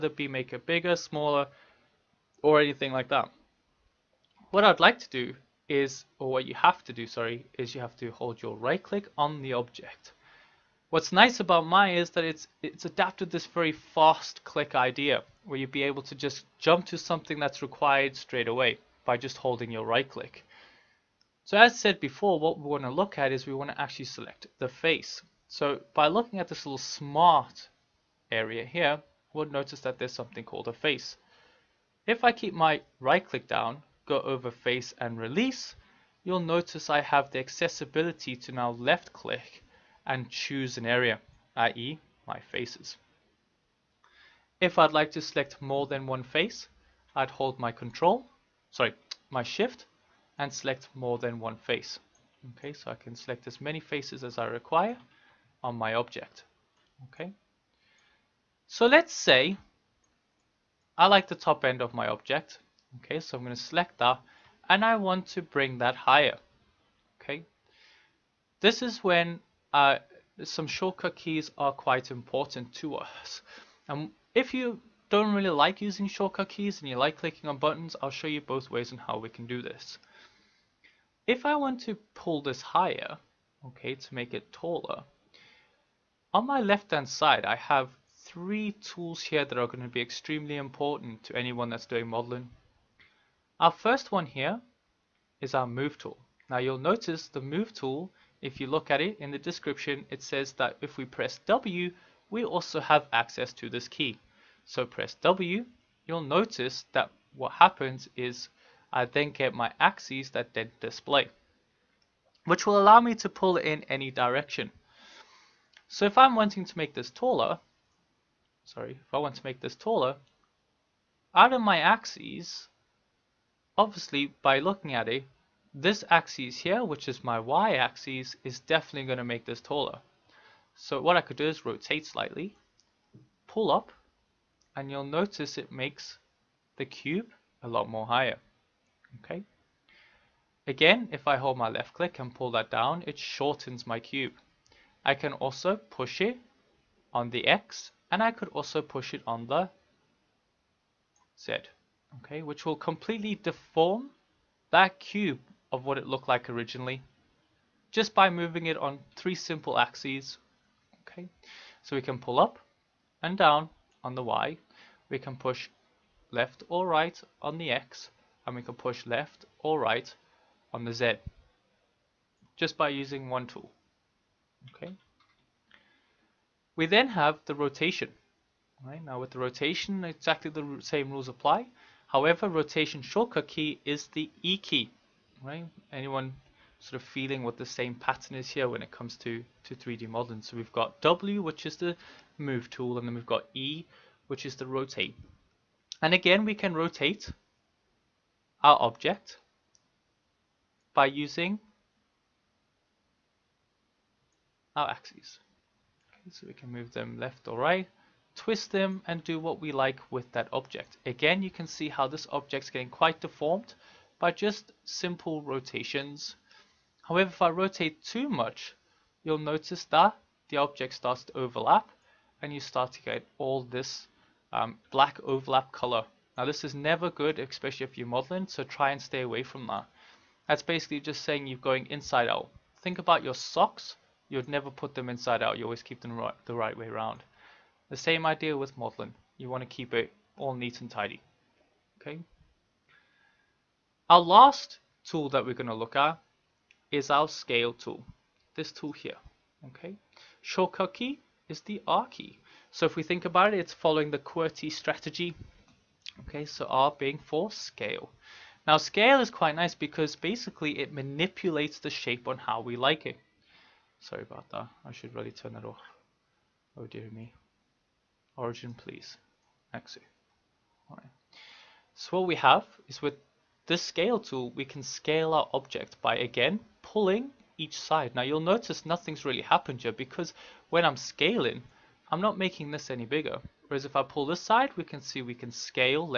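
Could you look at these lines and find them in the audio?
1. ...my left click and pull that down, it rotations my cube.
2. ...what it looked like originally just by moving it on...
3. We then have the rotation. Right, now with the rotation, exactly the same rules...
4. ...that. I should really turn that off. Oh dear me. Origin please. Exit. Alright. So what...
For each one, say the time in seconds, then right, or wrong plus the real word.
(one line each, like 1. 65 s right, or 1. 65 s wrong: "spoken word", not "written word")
1. 141 s wrong: "shortens", not "rotations"
2. 155 s right
3. 176 s right
4. 264 s right.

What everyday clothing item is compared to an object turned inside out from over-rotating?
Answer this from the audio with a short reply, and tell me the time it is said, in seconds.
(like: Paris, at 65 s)
socks, at 233 s.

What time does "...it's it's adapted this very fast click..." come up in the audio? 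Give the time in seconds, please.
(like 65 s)
12 s.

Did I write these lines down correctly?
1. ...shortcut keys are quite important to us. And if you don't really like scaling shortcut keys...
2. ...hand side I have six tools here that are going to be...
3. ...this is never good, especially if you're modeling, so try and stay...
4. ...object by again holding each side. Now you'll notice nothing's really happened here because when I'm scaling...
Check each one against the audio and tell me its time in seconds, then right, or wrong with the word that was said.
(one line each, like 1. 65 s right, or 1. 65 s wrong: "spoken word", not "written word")
1. 70 s wrong: "using", not "scaling"
2. 86 s wrong: "three", not "six"
3. 226 s right
4. 275 s wrong: "pulling", not "holding".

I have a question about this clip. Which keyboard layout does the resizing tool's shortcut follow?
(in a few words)
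QWERTY.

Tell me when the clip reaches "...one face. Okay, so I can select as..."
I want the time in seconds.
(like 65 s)
51 s.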